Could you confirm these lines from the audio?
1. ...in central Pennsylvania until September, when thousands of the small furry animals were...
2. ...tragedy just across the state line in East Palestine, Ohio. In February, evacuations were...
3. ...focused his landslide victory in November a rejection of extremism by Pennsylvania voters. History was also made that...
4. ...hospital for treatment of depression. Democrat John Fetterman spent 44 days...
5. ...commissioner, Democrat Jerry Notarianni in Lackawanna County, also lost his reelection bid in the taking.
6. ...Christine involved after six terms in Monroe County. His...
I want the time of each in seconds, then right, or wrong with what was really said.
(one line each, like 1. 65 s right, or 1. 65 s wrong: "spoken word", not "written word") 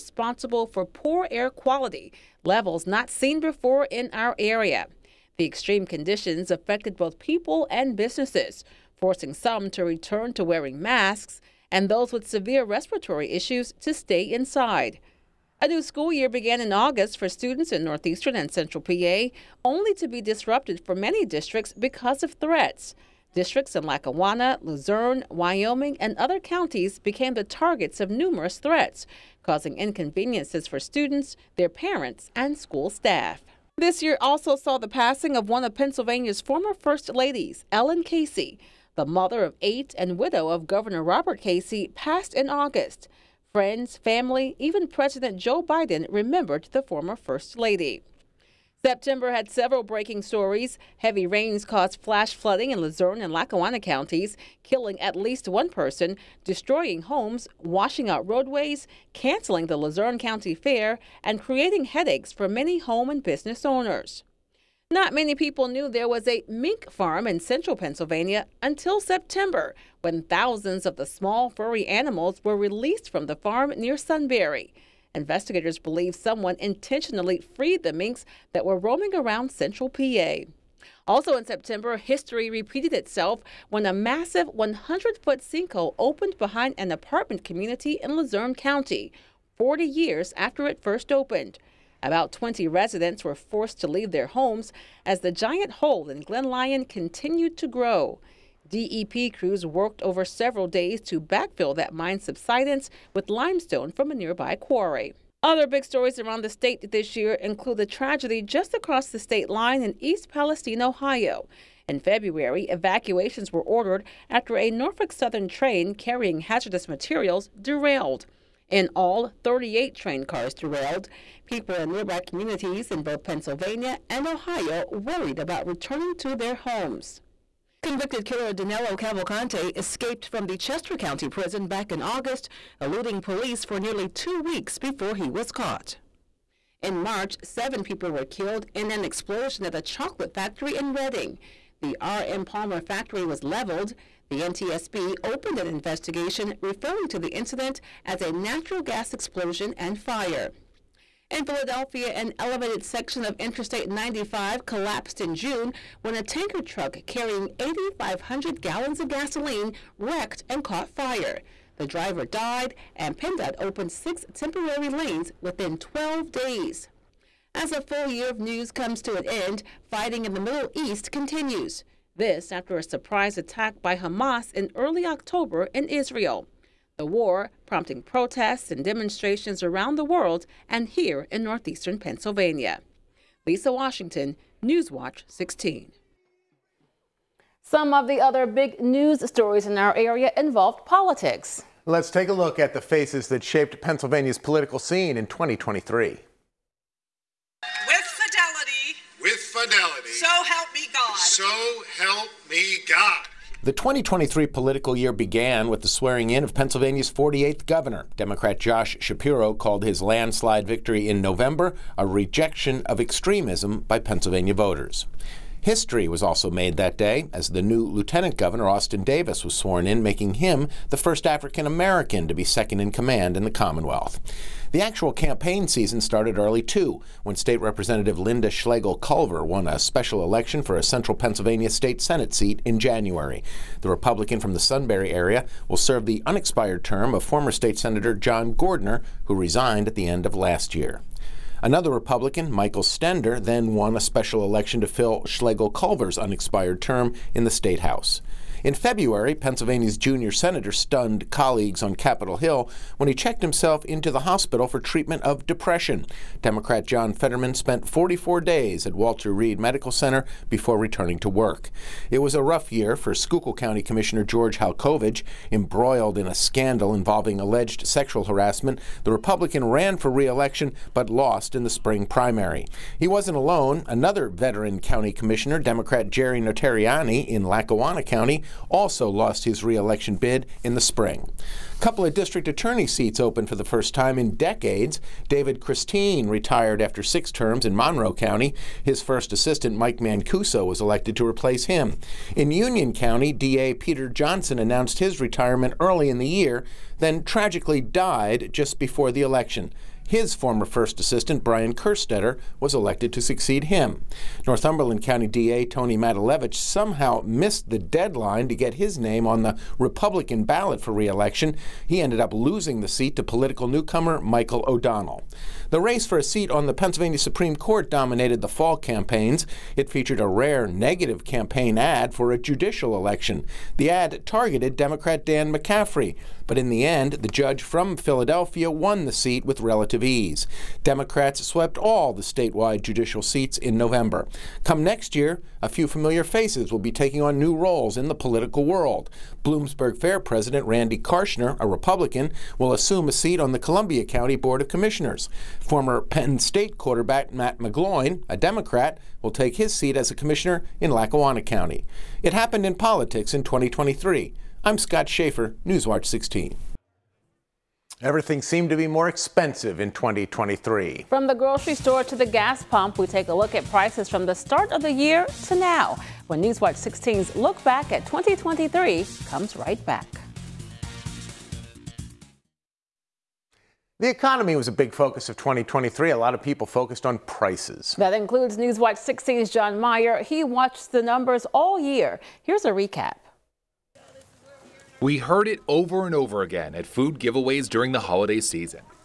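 1. 67 s right
2. 107 s right
3. 209 s wrong: "called", not "focused"
4. 254 s right
5. 275 s wrong: "spring", not "taking"
6. 285 s wrong: "retired", not "involved".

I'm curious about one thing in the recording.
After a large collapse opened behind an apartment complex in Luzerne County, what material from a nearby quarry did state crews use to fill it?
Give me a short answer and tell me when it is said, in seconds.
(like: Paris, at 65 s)
limestone, at 103 s.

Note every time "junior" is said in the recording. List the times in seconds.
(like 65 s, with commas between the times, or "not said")
249 s.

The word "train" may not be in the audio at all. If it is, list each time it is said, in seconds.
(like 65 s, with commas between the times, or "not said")
115 s, 119 s.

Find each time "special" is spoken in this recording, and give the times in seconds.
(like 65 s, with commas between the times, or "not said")
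229 s, 244 s.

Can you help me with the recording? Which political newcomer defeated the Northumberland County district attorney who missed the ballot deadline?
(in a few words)
Michael O'Donnell.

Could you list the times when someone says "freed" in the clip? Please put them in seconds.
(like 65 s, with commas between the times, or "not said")
77 s.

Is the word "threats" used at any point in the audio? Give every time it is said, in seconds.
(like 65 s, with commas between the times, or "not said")
22 s, 28 s.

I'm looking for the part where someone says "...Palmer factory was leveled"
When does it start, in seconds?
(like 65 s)
142 s.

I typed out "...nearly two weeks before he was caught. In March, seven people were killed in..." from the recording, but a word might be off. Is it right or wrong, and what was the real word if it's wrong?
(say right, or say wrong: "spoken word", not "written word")
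right.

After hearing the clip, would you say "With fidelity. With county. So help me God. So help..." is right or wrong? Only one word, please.
wrong.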